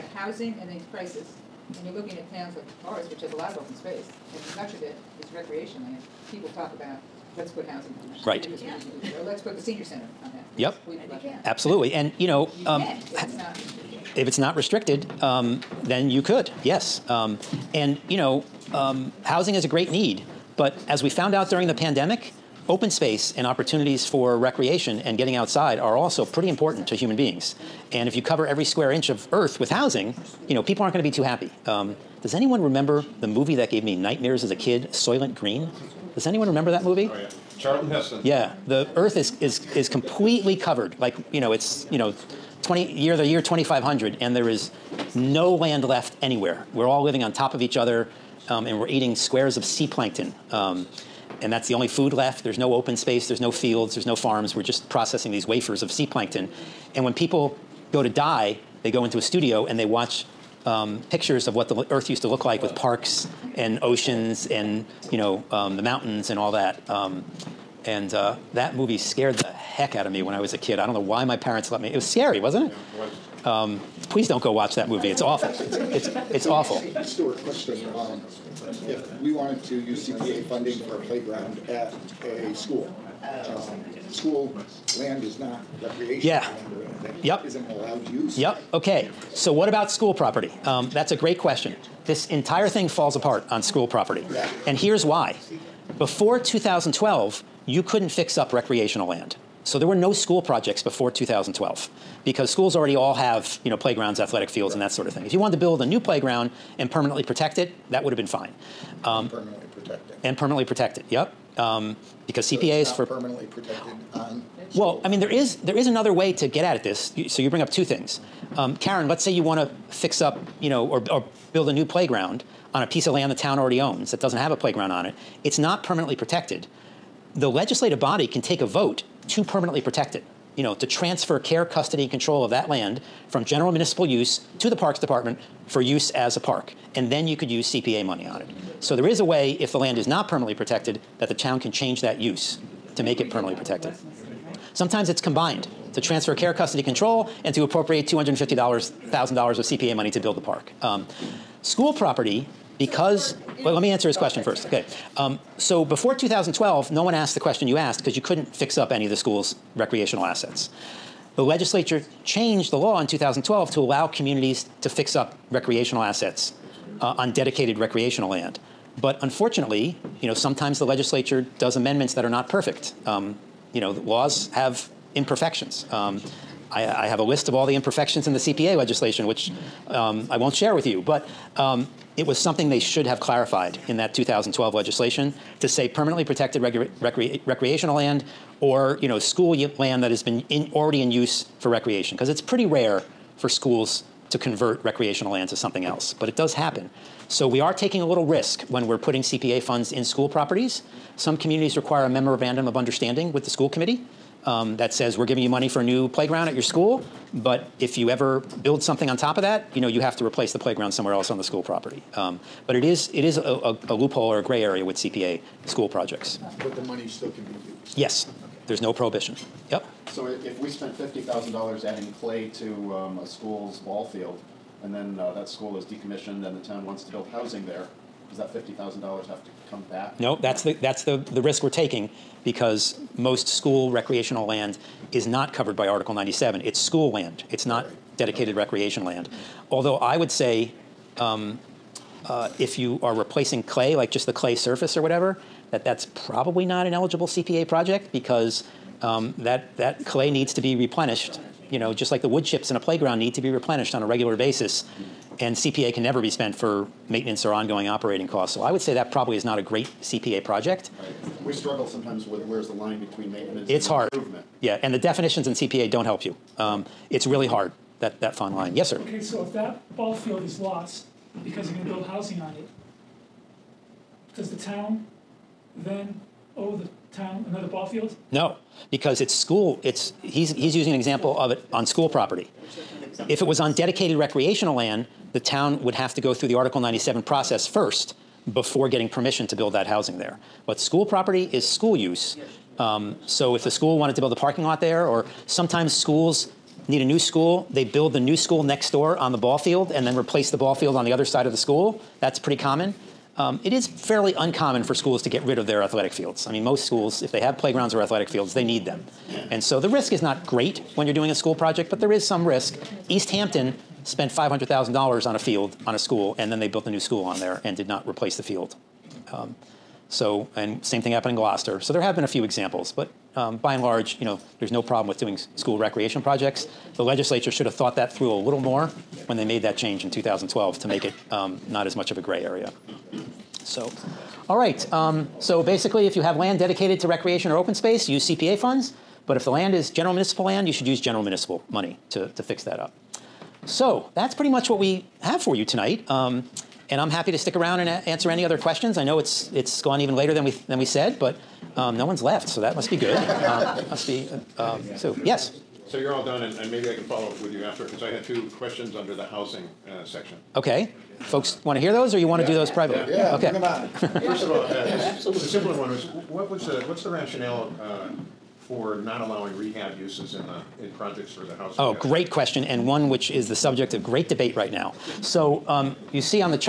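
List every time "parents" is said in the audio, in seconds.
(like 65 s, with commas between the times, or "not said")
71 s.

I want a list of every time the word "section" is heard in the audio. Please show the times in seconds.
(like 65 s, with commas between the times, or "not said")
360 s.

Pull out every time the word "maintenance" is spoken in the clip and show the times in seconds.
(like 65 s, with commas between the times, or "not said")
257 s, 263 s.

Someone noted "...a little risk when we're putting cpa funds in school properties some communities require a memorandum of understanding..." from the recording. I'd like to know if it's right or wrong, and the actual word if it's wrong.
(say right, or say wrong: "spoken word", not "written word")
right.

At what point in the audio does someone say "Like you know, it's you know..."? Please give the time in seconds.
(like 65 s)
40 s.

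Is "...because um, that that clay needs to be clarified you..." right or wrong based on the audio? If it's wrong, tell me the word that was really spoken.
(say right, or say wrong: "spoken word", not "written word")
wrong: "replenished", not "clarified".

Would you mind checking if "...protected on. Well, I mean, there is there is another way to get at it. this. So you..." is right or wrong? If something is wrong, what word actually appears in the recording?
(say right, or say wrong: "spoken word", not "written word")
right.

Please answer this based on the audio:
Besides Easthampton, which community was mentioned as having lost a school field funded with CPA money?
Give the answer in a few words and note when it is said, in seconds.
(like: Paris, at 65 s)
Gloucester, at 321 s.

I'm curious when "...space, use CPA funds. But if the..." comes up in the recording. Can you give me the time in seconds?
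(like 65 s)
337 s.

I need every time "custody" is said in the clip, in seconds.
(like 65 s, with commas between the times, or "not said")
131 s, 146 s.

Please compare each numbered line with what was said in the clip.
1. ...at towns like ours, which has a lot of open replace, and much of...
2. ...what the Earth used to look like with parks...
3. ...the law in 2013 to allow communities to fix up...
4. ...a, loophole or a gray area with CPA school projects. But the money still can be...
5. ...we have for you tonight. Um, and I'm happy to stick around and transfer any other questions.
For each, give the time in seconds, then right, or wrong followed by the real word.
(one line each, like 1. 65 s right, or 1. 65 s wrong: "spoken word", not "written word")
1. 2 s wrong: "space", not "replace"
2. 61 s right
3. 162 s wrong: "2012", not "2013"
4. 213 s right
5. 344 s wrong: "answer", not "transfer".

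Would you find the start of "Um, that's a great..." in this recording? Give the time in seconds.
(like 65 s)
90 s.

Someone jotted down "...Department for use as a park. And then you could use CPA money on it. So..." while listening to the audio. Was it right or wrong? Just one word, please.
right.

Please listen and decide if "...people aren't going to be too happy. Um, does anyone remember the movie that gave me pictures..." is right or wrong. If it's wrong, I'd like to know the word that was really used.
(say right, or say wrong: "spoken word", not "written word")
wrong: "nightmares", not "pictures".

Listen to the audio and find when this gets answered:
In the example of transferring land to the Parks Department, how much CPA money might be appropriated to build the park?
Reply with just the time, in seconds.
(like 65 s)
148 s.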